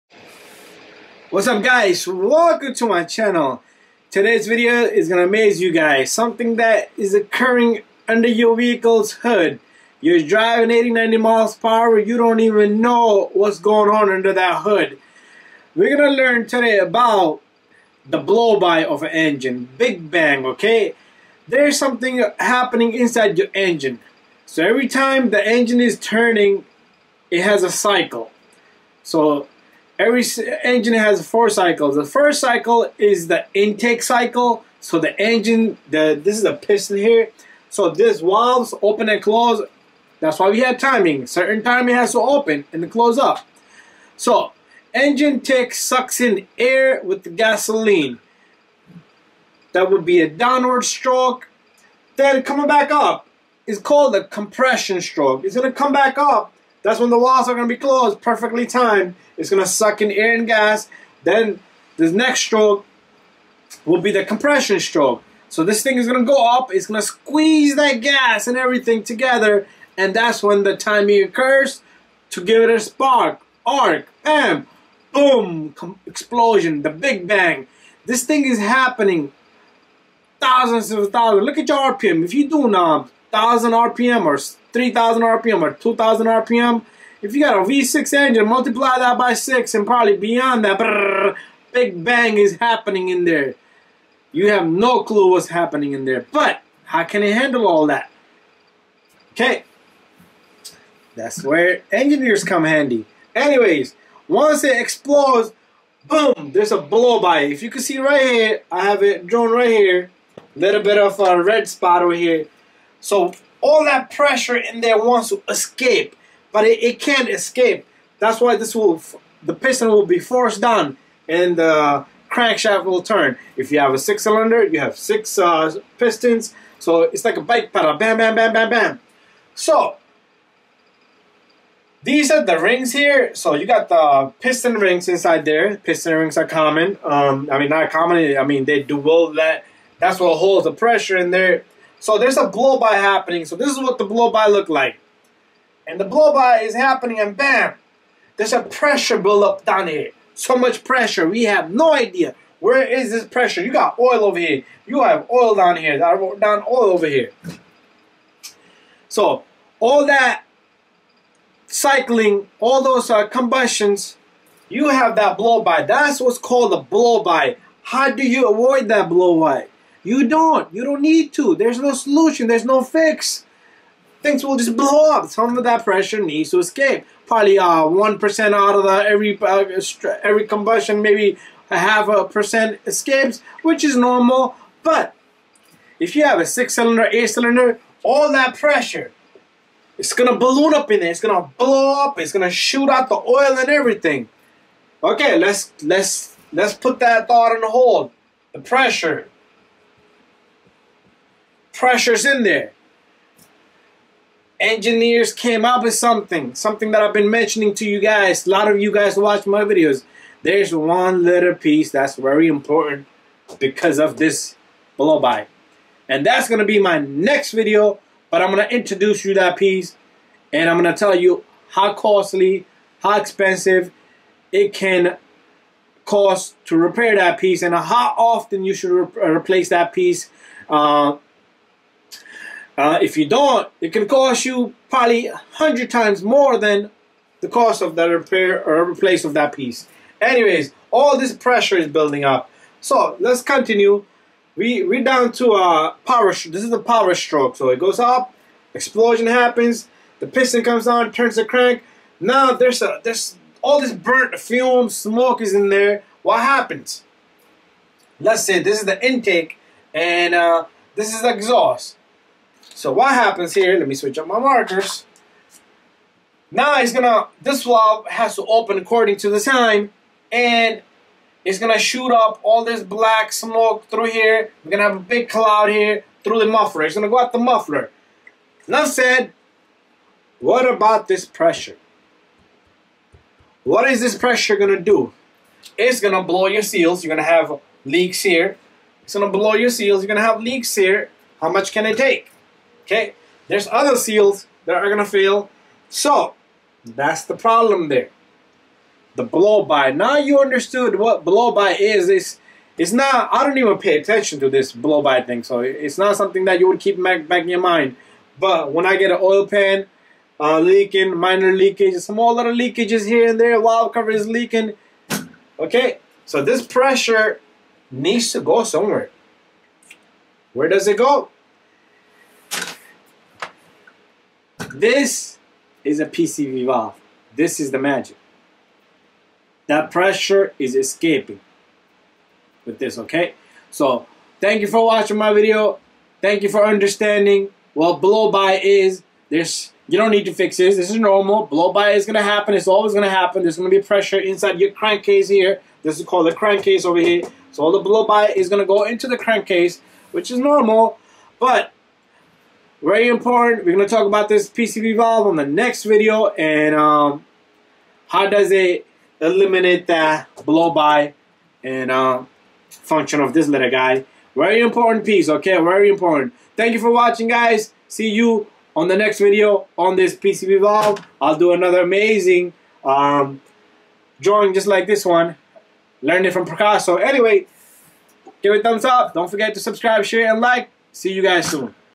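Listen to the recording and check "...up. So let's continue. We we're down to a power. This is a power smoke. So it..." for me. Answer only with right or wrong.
wrong.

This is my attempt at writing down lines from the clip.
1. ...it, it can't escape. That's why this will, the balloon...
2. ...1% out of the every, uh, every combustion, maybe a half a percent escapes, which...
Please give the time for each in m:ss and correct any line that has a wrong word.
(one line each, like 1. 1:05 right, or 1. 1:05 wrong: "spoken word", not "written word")
1. 1:56 wrong: "piston", not "balloon"
2. 2:57 right.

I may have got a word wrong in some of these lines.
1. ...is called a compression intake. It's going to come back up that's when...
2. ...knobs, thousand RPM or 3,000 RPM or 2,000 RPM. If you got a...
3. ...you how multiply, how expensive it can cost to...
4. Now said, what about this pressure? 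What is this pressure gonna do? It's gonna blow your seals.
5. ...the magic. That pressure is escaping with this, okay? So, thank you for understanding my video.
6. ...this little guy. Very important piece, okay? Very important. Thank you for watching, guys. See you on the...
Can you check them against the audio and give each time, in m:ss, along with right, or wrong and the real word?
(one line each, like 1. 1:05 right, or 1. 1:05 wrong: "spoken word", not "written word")
1. 0:53 wrong: "stroke", not "intake"
2. 1:22 right
3. 3:41 wrong: "costly", not "multiply"
4. 4:38 right
5. 5:27 wrong: "watching", not "understanding"
6. 6:03 right.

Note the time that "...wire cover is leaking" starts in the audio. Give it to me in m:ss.
5:13.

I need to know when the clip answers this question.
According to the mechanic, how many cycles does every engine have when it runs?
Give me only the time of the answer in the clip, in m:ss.
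0:31.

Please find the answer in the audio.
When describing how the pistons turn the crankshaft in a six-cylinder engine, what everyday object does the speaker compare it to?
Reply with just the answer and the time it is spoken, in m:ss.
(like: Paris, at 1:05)
bike pedal, at 2:07.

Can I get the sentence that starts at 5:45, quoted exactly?
This is called the crankcase over here.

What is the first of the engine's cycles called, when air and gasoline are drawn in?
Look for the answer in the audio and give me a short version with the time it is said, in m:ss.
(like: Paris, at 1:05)
intake cycle, at 0:33.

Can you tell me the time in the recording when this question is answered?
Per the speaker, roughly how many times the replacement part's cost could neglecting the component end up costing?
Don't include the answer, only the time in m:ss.
3:55.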